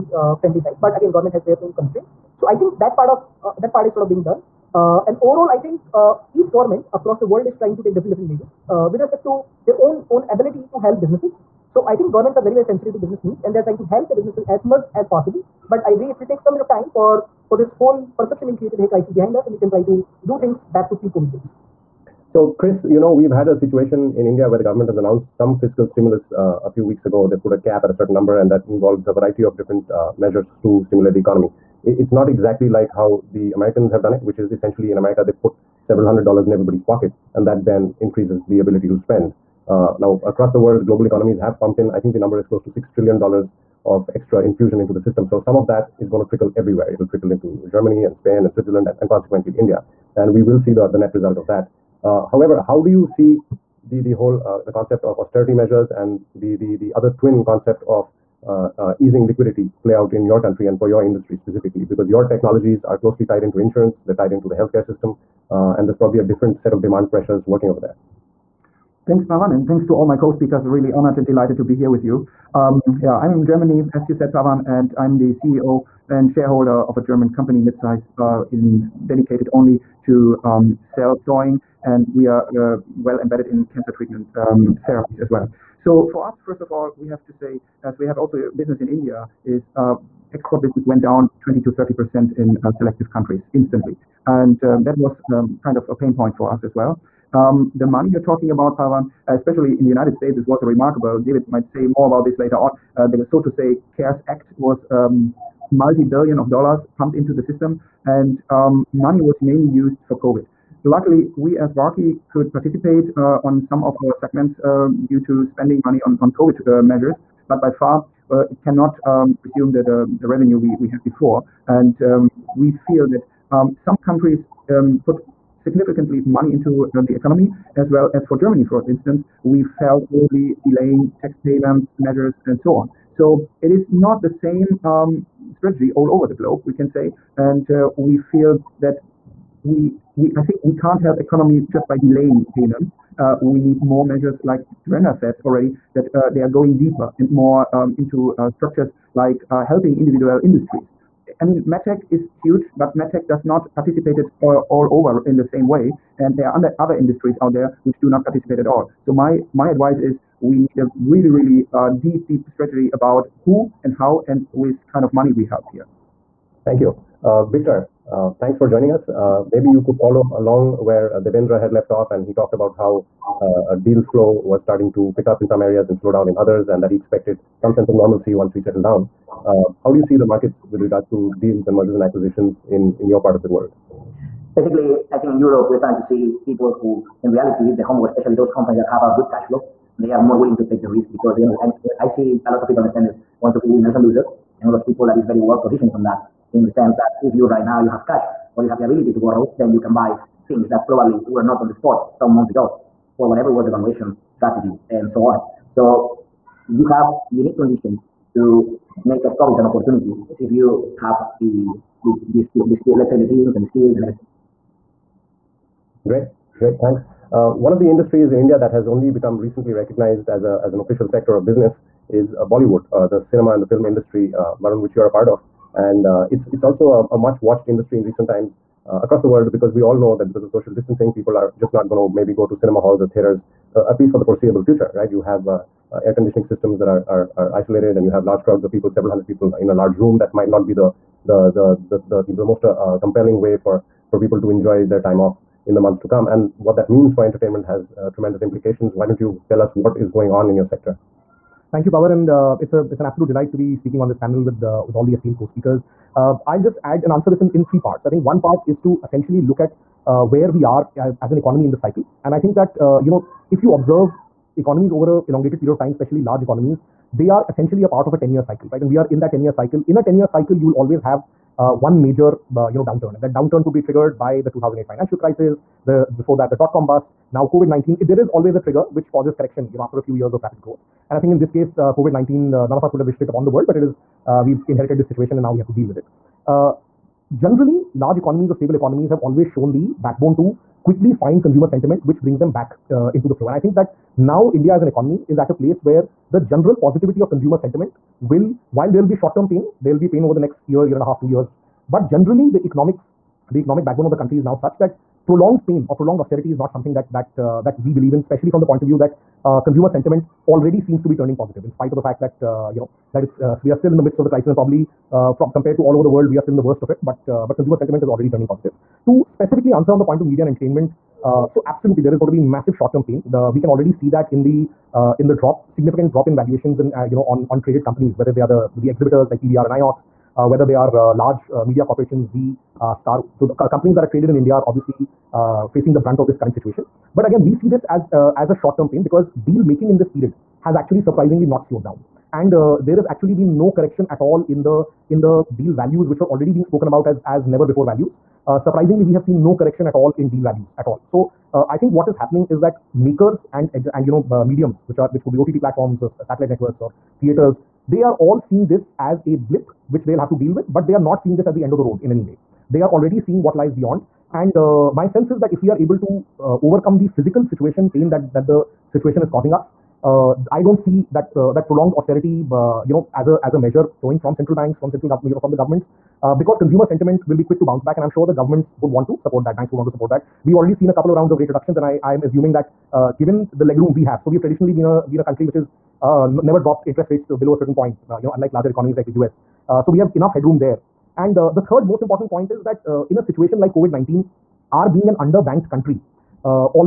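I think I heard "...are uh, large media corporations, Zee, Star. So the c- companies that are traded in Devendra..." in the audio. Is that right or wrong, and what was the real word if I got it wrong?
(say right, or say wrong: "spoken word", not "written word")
wrong: "India", not "Devendra".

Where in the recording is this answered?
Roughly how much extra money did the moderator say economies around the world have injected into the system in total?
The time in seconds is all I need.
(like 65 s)
42 s.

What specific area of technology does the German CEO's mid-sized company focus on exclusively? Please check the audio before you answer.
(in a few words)
cell thawing.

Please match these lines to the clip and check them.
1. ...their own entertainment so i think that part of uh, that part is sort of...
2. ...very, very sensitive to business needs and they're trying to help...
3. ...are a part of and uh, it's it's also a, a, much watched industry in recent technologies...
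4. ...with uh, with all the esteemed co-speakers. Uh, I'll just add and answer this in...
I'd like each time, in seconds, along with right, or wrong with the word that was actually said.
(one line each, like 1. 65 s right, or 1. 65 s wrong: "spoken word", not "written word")
1. 1 s wrong: "constraint", not "entertainment"
2. 12 s right
3. 225 s wrong: "times", not "technologies"
4. 254 s right.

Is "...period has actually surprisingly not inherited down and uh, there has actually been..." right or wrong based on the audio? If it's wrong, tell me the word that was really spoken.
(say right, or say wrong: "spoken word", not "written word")
wrong: "slowed", not "inherited".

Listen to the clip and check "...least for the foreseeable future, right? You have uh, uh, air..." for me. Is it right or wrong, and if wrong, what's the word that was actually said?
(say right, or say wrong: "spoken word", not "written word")
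right.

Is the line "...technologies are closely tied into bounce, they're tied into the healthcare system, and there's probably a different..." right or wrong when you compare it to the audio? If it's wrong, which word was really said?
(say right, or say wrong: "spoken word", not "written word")
wrong: "insurance", not "bounce".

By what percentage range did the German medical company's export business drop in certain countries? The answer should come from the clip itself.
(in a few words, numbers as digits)
20 to 30 percent.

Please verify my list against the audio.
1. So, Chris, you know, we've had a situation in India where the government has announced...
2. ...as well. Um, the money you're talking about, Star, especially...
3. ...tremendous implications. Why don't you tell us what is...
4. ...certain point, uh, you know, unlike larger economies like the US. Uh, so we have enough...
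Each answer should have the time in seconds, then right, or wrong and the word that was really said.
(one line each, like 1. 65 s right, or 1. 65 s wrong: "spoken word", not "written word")
1. 22 s right
2. 96 s wrong: "Pavan", not "Star"
3. 248 s right
4. 387 s right.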